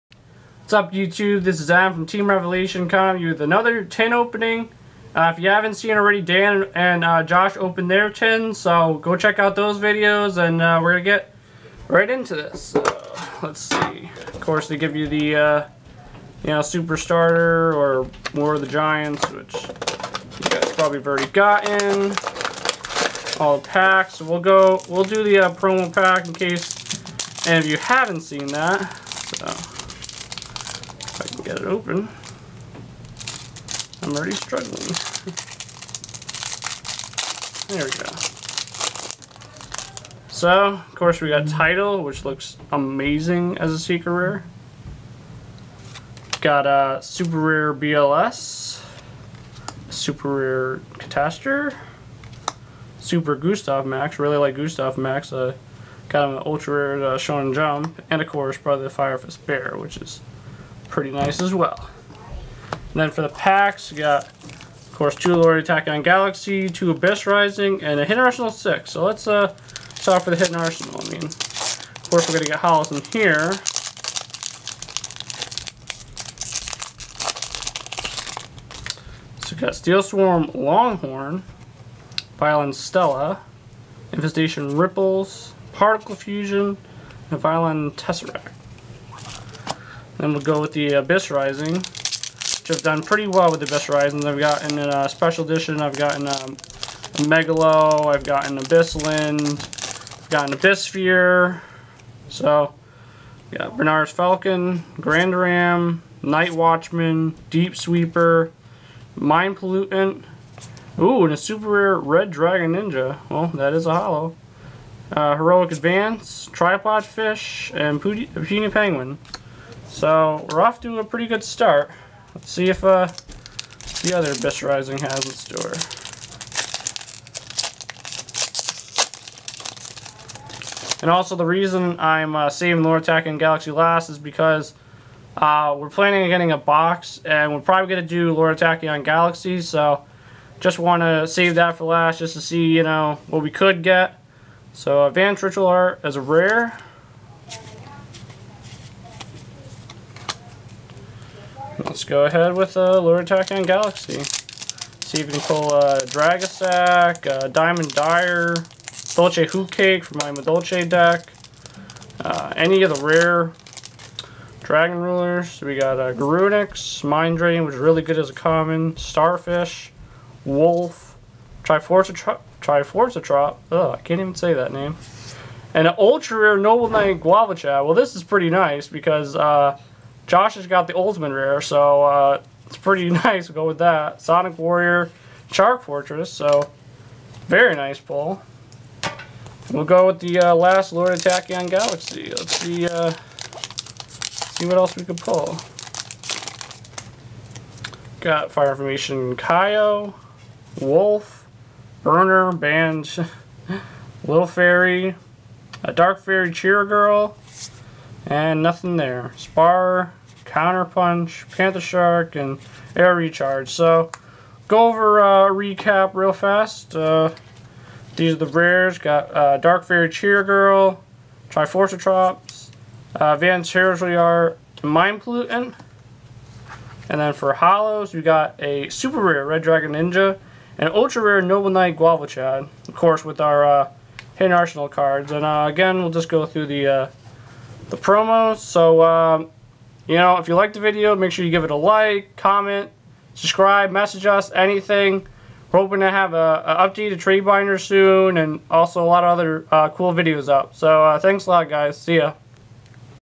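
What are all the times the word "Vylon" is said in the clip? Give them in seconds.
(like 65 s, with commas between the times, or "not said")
82 s, 87 s.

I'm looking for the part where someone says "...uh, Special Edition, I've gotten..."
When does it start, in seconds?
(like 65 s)
94 s.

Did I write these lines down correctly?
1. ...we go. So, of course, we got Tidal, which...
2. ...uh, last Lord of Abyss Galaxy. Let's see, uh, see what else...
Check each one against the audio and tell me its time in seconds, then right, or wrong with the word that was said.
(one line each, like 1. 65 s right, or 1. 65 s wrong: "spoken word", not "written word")
1. 37 s right
2. 190 s wrong: "Tachyon", not "Abyss".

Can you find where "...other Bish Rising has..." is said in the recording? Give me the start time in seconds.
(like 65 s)
124 s.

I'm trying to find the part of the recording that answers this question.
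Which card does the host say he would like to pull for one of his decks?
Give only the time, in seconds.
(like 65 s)
159 s.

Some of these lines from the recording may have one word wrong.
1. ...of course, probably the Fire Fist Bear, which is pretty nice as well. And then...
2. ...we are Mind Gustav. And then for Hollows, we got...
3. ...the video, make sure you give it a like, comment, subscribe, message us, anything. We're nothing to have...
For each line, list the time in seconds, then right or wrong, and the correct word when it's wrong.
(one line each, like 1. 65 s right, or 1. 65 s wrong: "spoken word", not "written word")
1. 58 s right
2. 224 s wrong: "Pollutant", not "Gustav"
3. 240 s wrong: "hoping", not "nothing".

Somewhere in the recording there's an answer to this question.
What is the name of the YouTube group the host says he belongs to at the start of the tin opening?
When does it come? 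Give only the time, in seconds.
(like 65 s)
2 s.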